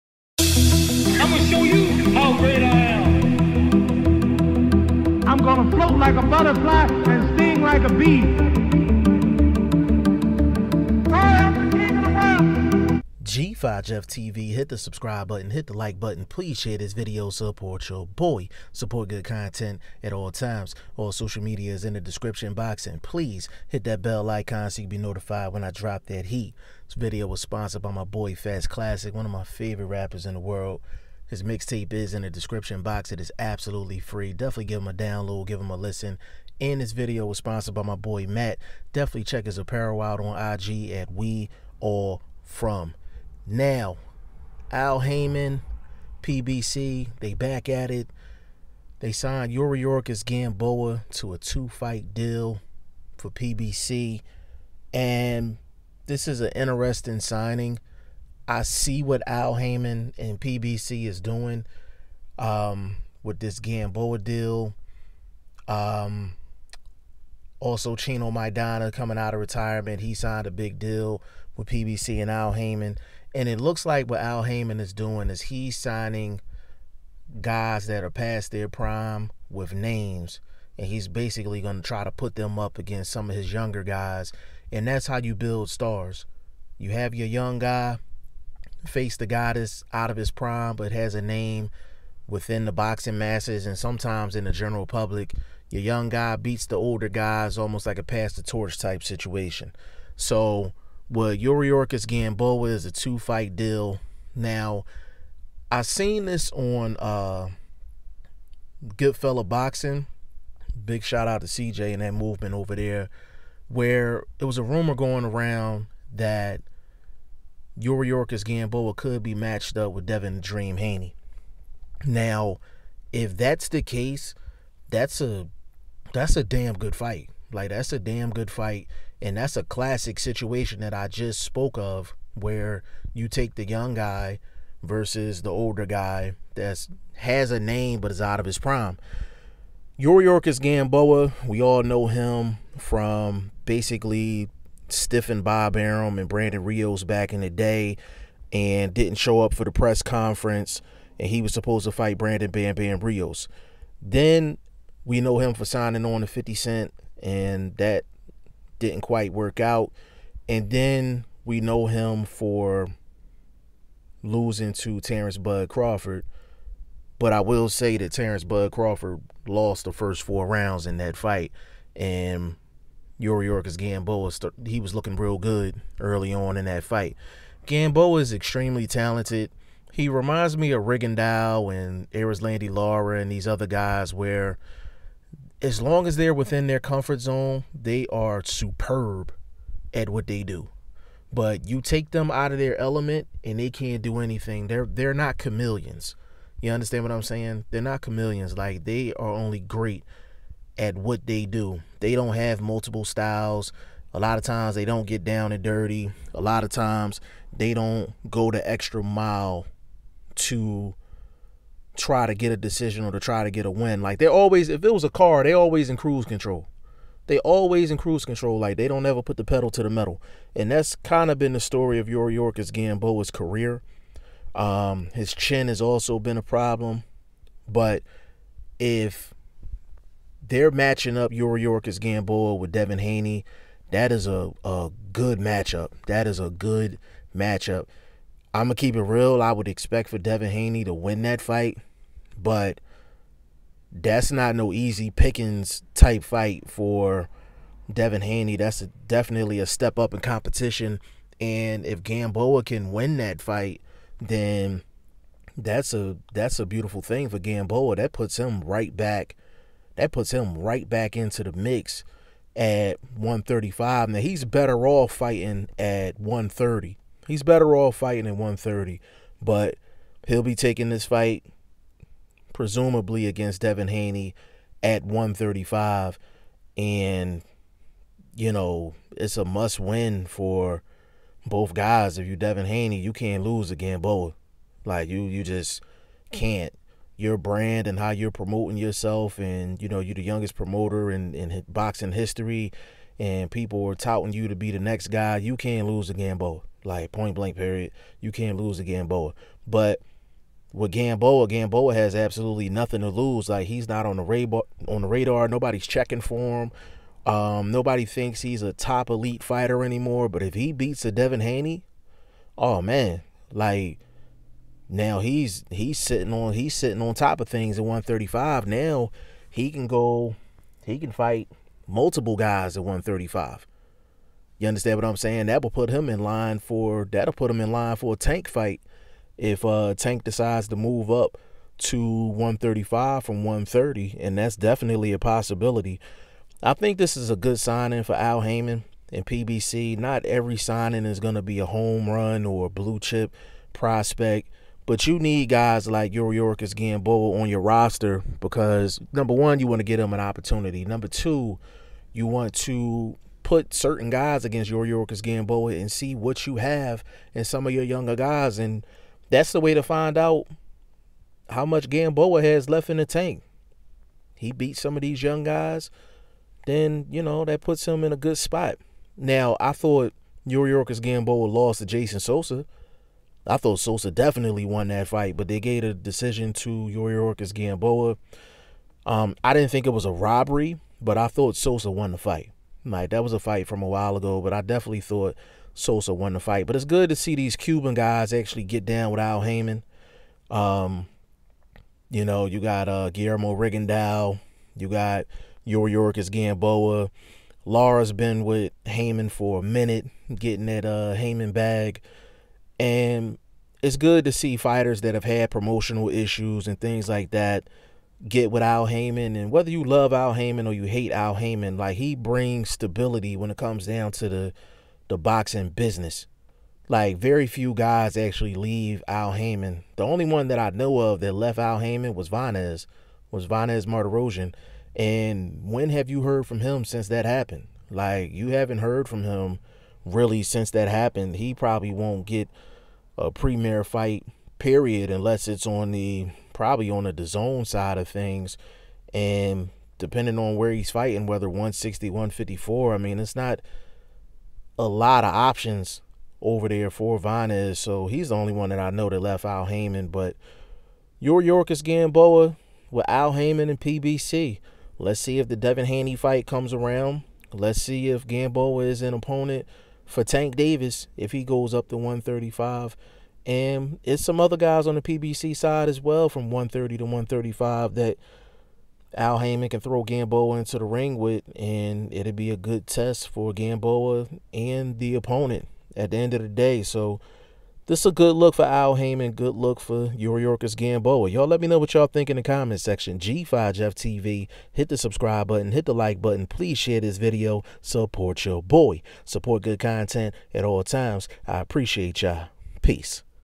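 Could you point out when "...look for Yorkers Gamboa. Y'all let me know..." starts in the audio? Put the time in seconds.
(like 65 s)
479 s.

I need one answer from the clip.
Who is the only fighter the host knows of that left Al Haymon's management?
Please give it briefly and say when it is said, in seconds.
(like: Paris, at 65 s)
Vanes Martirosyan, at 423 s.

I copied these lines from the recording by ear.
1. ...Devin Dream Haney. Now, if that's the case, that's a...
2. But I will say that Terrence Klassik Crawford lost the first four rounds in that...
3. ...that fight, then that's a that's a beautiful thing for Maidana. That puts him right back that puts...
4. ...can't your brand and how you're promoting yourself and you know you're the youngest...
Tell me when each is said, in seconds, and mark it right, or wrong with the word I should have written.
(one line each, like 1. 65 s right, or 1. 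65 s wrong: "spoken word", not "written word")
1. 120 s right
2. 167 s wrong: "Bud", not "Klassik"
3. 253 s wrong: "Gamboa", not "Maidana"
4. 286 s right.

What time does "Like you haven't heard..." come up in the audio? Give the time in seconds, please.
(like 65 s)
427 s.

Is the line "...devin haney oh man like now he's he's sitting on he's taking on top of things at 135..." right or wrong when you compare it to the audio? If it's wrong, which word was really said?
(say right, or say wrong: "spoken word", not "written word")
wrong: "sitting", not "taking".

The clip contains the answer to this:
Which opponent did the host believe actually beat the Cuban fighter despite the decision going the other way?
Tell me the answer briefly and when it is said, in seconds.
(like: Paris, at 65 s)
Jason Sosa, at 371 s.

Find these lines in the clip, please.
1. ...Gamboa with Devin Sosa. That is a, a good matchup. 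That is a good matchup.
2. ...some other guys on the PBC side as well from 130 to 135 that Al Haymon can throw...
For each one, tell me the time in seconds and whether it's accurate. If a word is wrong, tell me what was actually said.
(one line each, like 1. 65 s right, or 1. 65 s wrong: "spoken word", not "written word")
1. 232 s wrong: "Haney", not "Sosa"
2. 464 s right.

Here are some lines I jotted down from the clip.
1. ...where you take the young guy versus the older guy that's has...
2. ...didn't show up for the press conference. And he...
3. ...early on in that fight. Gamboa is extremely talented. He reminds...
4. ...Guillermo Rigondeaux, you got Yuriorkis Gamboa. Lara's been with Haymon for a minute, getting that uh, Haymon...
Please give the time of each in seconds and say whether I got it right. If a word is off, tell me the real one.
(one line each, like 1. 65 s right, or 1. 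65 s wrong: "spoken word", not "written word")
1. 132 s right
2. 148 s right
3. 175 s right
4. 393 s right.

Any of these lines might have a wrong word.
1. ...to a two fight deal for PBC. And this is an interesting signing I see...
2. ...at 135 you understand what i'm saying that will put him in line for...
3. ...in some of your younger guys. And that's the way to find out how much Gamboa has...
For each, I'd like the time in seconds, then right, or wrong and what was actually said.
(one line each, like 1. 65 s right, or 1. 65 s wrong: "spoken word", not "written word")
1. 51 s right
2. 322 s right
3. 357 s right.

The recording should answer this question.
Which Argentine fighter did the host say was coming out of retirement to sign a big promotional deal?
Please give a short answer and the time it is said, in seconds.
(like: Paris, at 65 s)
Chino Maidana, at 67 s.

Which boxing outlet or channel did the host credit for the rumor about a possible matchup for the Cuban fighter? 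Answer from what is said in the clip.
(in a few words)
Goodfella Boxing.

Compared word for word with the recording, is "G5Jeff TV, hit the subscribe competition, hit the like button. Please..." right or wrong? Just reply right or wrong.
wrong.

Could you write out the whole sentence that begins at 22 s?
And please hit that bell icon so you be notified when I drop that heat.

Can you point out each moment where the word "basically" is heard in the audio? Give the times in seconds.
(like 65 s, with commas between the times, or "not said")
81 s, 143 s.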